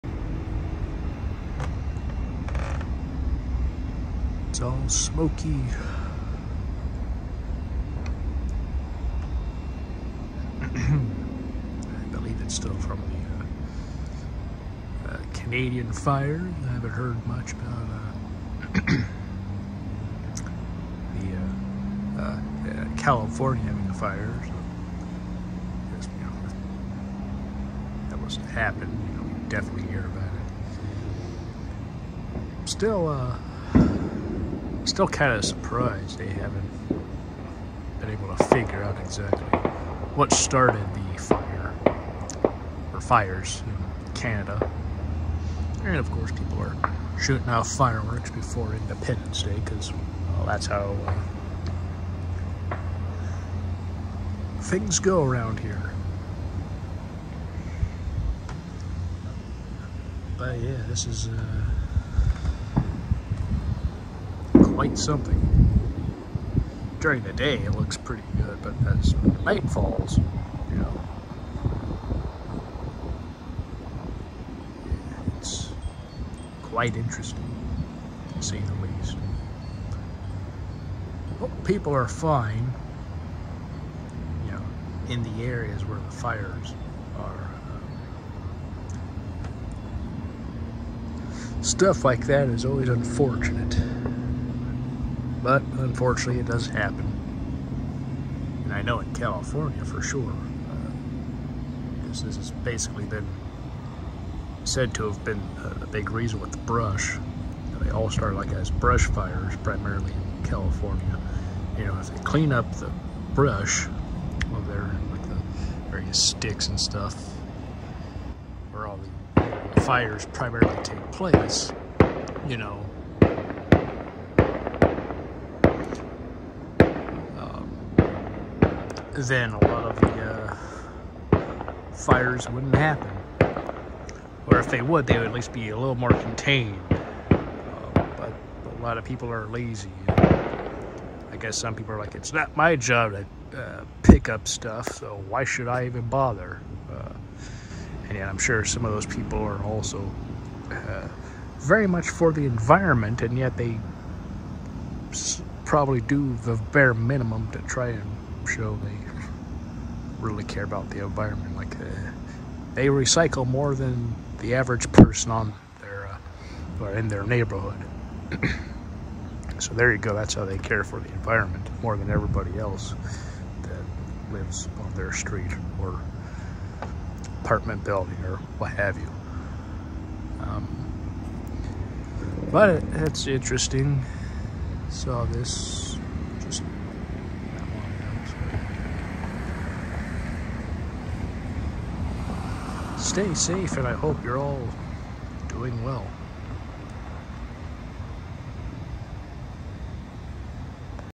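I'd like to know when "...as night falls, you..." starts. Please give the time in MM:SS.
01:08.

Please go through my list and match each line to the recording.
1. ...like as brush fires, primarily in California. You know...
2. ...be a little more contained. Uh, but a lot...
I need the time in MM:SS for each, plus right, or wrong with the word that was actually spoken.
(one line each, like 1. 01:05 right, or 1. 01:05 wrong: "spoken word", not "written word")
1. 01:48 right
2. 02:15 right.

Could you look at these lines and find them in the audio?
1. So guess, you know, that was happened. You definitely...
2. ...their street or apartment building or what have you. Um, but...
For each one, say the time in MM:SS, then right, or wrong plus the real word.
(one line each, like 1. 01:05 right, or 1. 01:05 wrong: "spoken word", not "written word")
1. 00:24 right
2. 02:54 right.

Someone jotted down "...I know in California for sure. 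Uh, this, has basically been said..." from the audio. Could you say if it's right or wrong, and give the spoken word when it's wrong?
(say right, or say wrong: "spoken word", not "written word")
right.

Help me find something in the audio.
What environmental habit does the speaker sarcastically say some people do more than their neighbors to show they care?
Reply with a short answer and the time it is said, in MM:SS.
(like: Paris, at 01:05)
Recycle, at 02:42.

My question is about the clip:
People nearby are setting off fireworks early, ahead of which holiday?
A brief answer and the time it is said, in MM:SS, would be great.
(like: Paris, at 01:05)
Independence Day, at 00:48.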